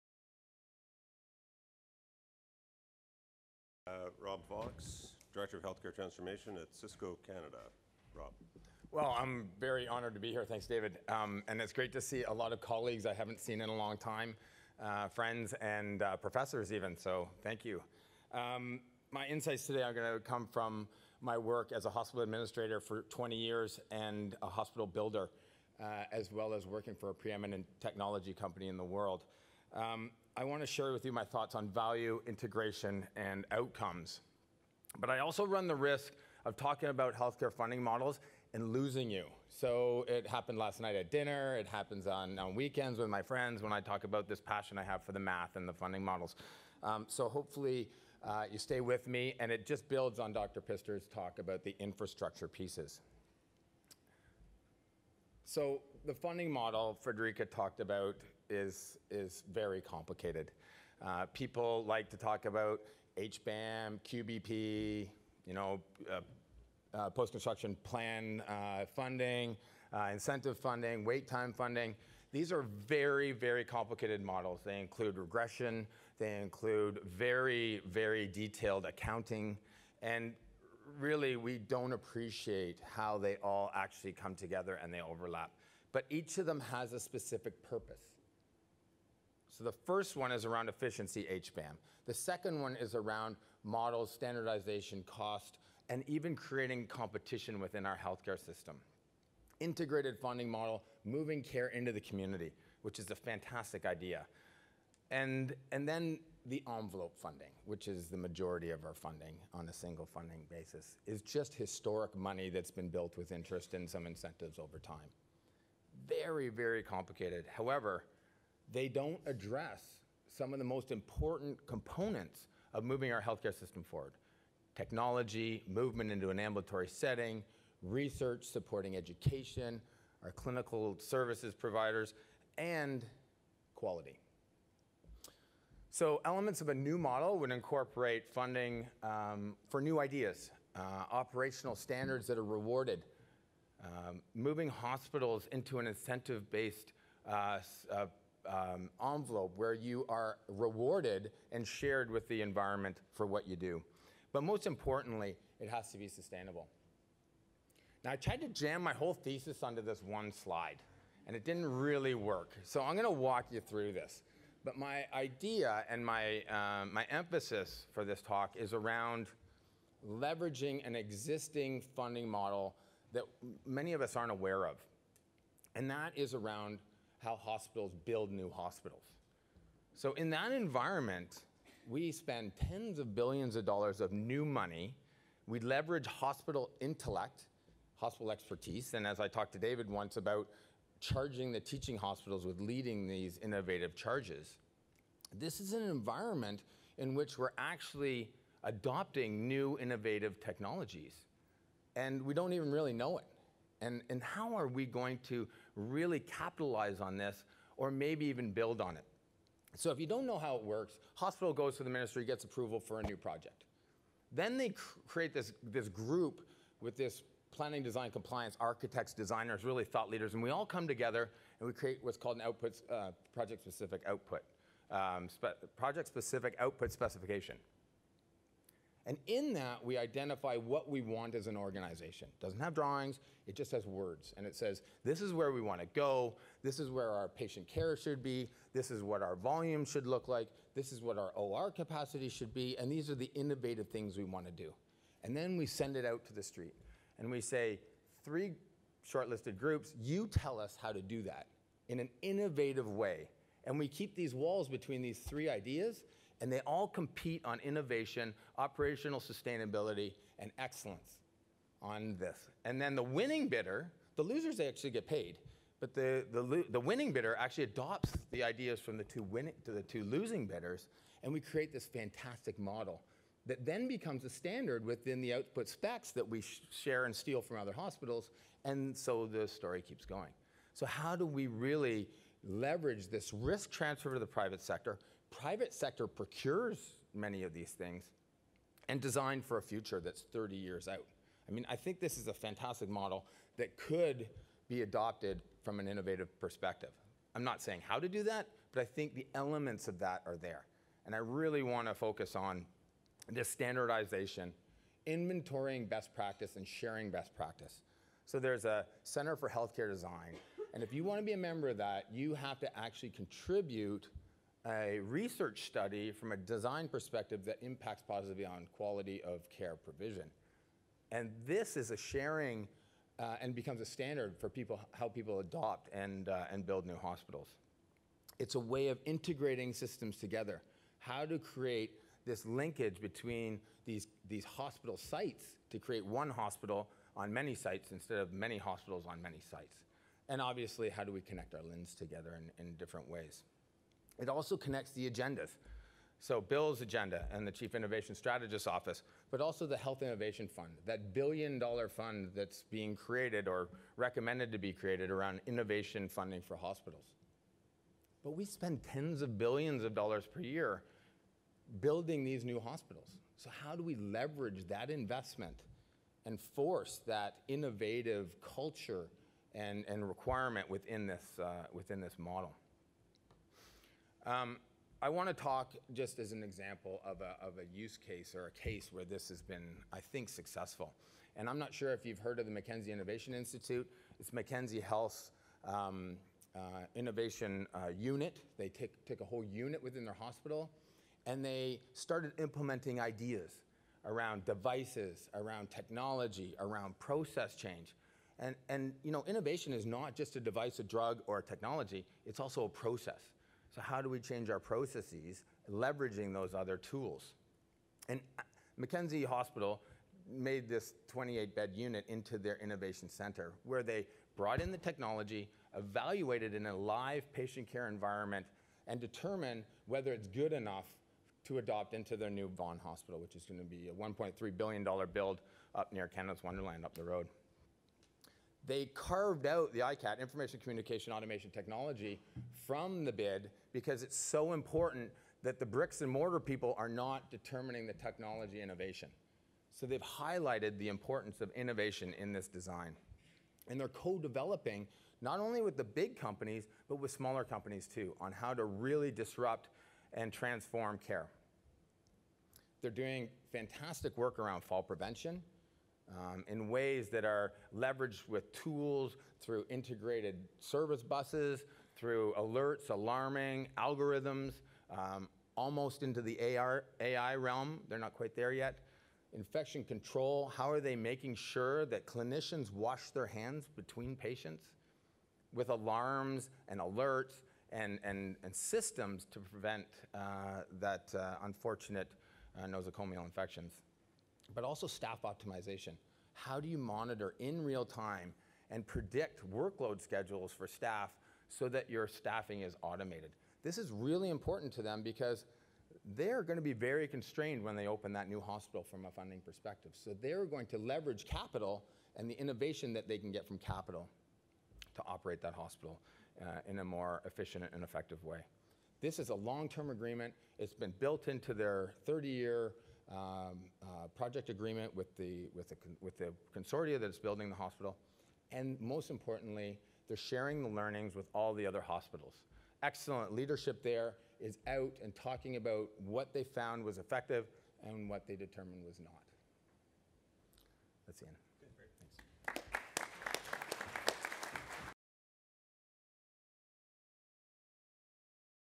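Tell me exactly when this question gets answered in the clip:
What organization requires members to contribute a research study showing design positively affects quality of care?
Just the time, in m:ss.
5:09.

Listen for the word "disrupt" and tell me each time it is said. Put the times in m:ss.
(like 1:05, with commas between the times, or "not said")
7:29.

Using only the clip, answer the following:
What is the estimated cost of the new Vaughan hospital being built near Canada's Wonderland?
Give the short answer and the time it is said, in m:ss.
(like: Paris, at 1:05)
$1.3 billion, at 7:03.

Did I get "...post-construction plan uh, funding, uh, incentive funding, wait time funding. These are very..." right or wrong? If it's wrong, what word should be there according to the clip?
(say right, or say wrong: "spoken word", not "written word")
right.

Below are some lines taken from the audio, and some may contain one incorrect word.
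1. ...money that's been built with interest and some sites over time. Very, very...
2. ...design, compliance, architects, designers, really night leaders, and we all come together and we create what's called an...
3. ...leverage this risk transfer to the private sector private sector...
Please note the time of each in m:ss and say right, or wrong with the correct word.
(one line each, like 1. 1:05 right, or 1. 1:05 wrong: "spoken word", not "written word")
1. 1:52 wrong: "incentives", not "sites"
2. 3:37 wrong: "thought", not "night"
3. 4:42 right.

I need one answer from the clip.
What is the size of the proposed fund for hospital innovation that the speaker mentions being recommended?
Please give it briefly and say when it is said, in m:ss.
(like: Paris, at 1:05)
$1 billion, at 5:51.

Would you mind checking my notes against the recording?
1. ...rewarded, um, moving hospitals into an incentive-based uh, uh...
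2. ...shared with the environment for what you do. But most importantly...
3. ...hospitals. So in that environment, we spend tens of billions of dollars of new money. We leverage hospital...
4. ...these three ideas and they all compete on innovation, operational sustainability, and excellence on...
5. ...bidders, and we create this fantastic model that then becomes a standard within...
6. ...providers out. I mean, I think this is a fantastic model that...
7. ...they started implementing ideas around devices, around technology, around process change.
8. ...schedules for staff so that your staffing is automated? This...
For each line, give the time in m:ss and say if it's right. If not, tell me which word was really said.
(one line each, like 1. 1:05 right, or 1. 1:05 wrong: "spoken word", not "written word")
1. 2:22 right
2. 2:31 right
3. 2:58 right
4. 4:15 right
5. 4:30 right
6. 4:50 wrong: "years", not "providers"
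7. 6:31 right
8. 8:10 right.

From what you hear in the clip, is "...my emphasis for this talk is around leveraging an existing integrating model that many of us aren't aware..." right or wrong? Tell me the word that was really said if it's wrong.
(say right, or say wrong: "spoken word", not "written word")
wrong: "funding", not "integrating".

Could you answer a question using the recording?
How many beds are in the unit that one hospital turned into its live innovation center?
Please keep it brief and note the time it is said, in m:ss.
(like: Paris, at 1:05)
28, at 6:51.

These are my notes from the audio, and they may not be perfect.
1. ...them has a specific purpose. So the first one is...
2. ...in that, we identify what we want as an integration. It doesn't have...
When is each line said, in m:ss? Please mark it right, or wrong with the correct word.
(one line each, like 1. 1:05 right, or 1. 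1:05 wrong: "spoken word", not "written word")
1. 1:26 right
2. 3:49 wrong: "organization", not "integration".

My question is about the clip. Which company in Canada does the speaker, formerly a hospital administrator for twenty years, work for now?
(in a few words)
Cisco.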